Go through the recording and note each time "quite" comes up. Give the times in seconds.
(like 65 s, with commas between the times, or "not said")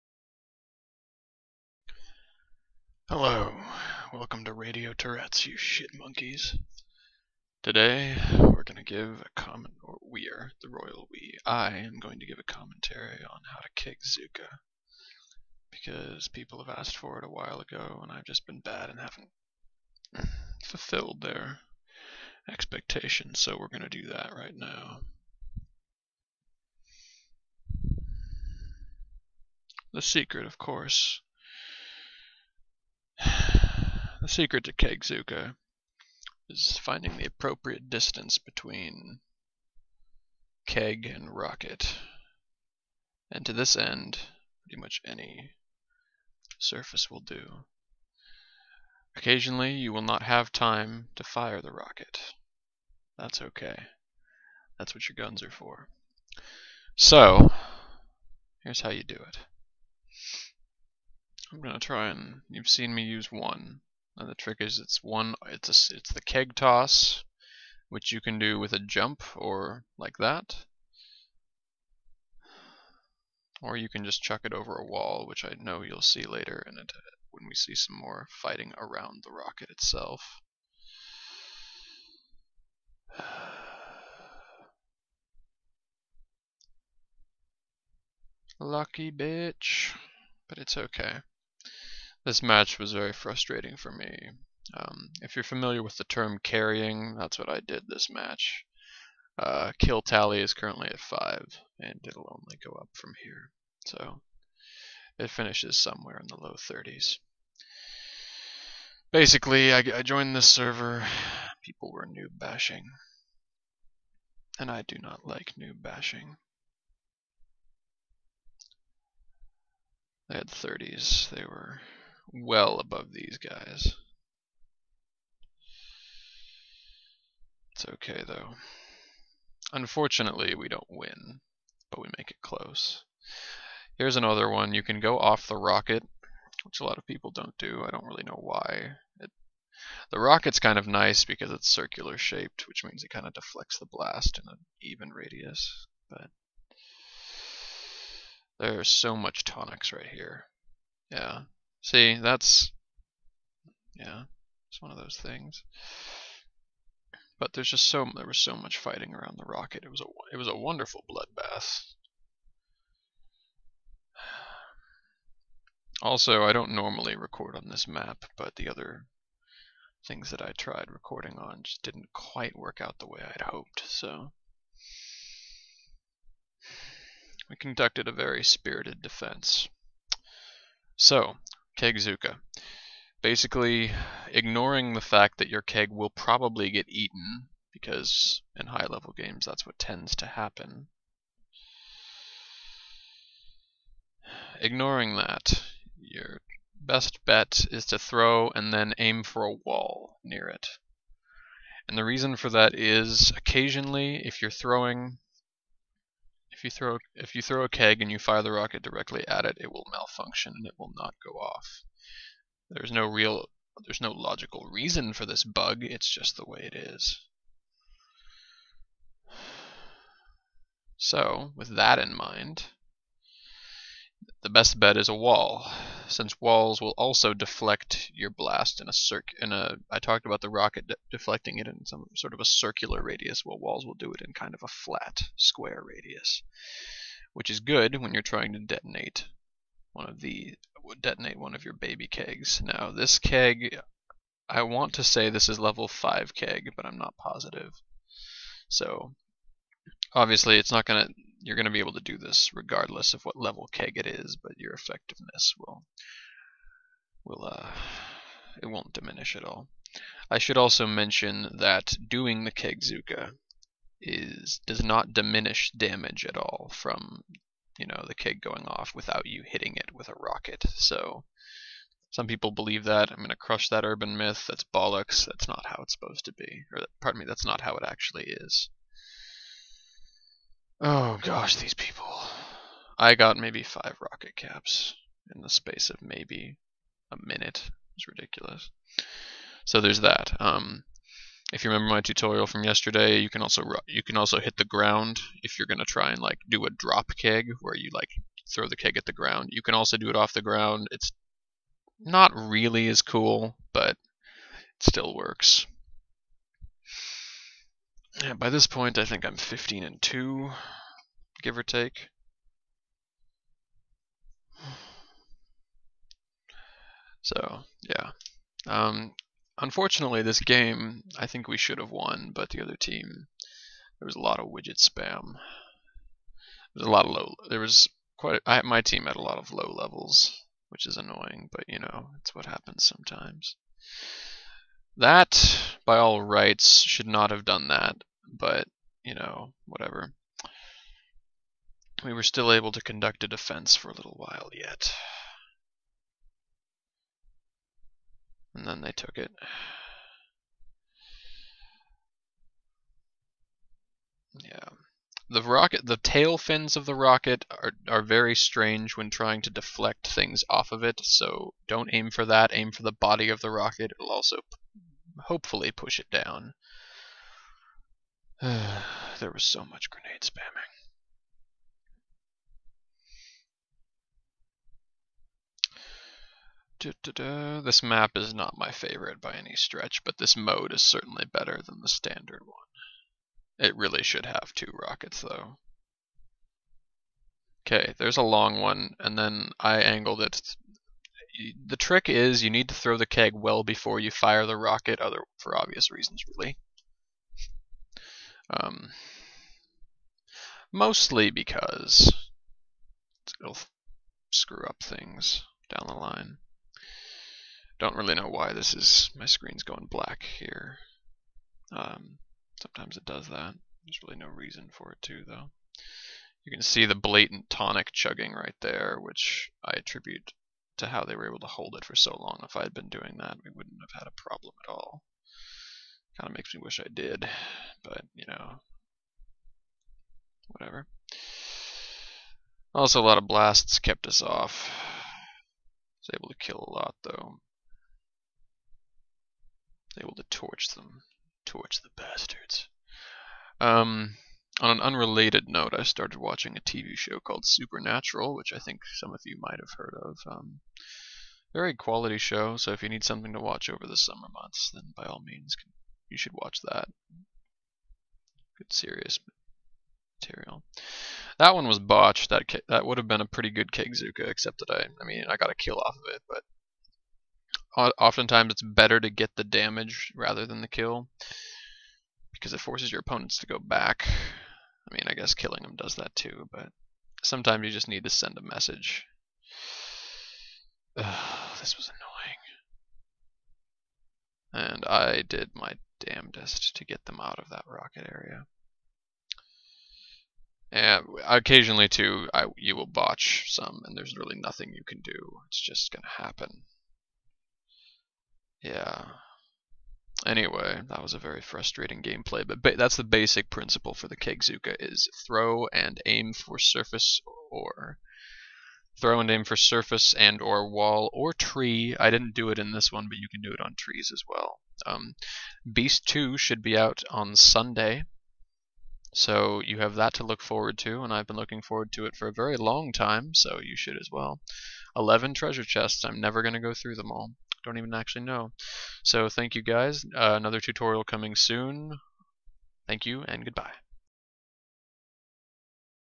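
172 s, 328 s.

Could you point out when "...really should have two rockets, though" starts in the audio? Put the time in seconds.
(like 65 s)
383 s.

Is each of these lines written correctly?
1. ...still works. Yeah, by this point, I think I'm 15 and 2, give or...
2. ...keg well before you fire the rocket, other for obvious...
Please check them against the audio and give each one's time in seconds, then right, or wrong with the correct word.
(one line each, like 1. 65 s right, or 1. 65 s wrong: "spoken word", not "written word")
1. 304 s right
2. 393 s right.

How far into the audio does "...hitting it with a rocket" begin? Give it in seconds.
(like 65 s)
269 s.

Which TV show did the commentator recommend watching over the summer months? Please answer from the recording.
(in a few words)
Supernatural.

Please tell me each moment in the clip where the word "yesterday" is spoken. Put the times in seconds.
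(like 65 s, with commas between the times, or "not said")
292 s.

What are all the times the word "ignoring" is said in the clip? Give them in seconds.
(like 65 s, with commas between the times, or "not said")
184 s, 194 s.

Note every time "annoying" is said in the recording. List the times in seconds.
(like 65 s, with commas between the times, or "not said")
330 s, 484 s.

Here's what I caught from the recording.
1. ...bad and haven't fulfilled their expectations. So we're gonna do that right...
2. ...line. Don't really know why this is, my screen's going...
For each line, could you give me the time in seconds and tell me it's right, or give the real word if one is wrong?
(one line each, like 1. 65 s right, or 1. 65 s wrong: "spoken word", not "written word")
1. 18 s right
2. 405 s right.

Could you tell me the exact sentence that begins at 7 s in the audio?
Today we're gonna give a comment, or we are the royal we.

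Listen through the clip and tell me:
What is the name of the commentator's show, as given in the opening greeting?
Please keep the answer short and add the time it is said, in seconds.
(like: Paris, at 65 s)
Radio Tourette's, at 4 s.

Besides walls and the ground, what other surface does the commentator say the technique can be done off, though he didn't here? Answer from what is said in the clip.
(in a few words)
trees.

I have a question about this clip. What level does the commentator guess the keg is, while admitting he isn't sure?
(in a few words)
level five.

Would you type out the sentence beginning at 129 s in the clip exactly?
Unfortunately, we don't win, but we make it close.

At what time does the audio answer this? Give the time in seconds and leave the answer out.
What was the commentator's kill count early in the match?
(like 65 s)
100 s.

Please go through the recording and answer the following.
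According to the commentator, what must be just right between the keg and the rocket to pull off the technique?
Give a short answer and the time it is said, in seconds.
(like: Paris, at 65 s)
distance, at 37 s.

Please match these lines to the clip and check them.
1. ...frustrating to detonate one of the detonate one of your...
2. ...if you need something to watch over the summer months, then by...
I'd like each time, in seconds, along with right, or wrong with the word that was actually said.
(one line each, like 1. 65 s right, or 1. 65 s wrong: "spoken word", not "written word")
1. 238 s wrong: "trying", not "frustrating"
2. 452 s right.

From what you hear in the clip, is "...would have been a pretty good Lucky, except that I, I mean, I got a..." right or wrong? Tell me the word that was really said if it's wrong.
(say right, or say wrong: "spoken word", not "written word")
wrong: "Kegzooka", not "Lucky".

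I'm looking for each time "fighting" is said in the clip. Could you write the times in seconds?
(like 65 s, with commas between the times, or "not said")
78 s, 158 s.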